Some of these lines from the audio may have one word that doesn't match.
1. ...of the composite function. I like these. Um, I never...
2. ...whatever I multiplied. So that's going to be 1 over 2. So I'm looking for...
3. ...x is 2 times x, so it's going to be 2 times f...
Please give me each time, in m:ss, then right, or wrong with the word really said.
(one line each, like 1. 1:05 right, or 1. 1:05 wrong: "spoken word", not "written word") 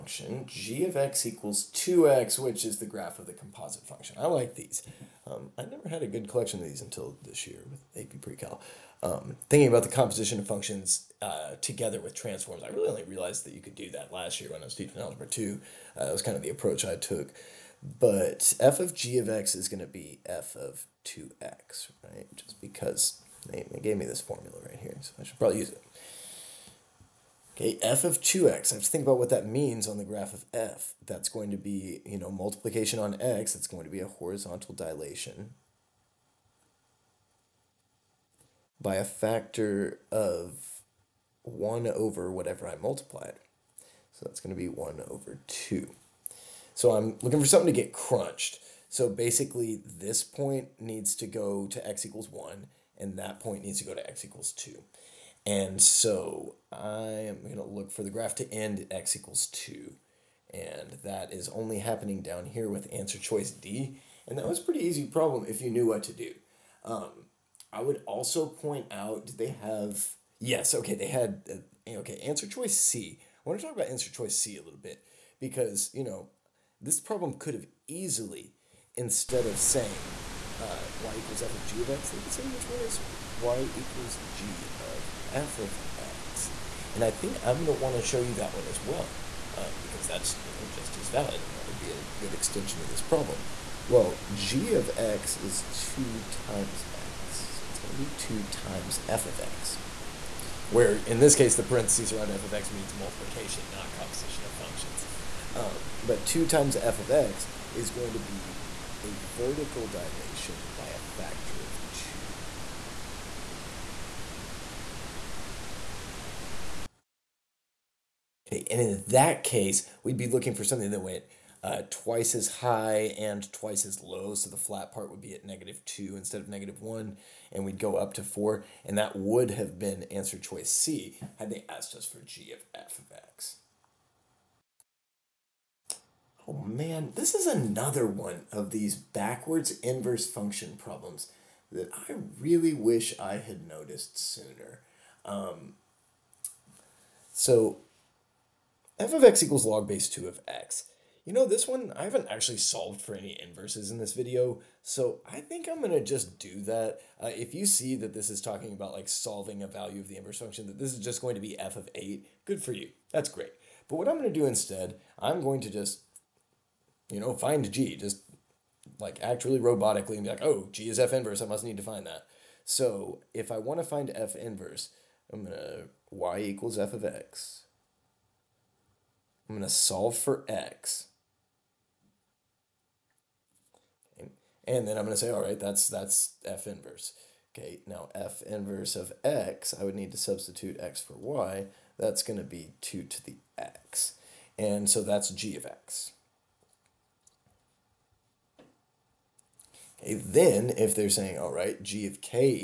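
1. 0:03 right
2. 0:42 right
3. 1:34 right.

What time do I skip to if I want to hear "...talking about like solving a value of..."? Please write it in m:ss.
2:38.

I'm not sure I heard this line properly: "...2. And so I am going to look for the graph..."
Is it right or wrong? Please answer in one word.
right.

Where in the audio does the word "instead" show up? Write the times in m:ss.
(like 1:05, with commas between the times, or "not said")
1:18, 2:06, 2:44.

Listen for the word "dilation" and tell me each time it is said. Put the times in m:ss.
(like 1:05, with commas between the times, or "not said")
0:34, 1:49.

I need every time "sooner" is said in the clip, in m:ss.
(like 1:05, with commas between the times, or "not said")
2:24.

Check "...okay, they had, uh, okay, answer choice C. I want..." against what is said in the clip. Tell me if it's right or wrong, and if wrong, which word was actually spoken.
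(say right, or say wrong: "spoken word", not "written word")
right.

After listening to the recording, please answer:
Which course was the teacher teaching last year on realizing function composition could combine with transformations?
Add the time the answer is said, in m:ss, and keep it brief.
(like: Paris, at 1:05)
Algebra 2, at 0:15.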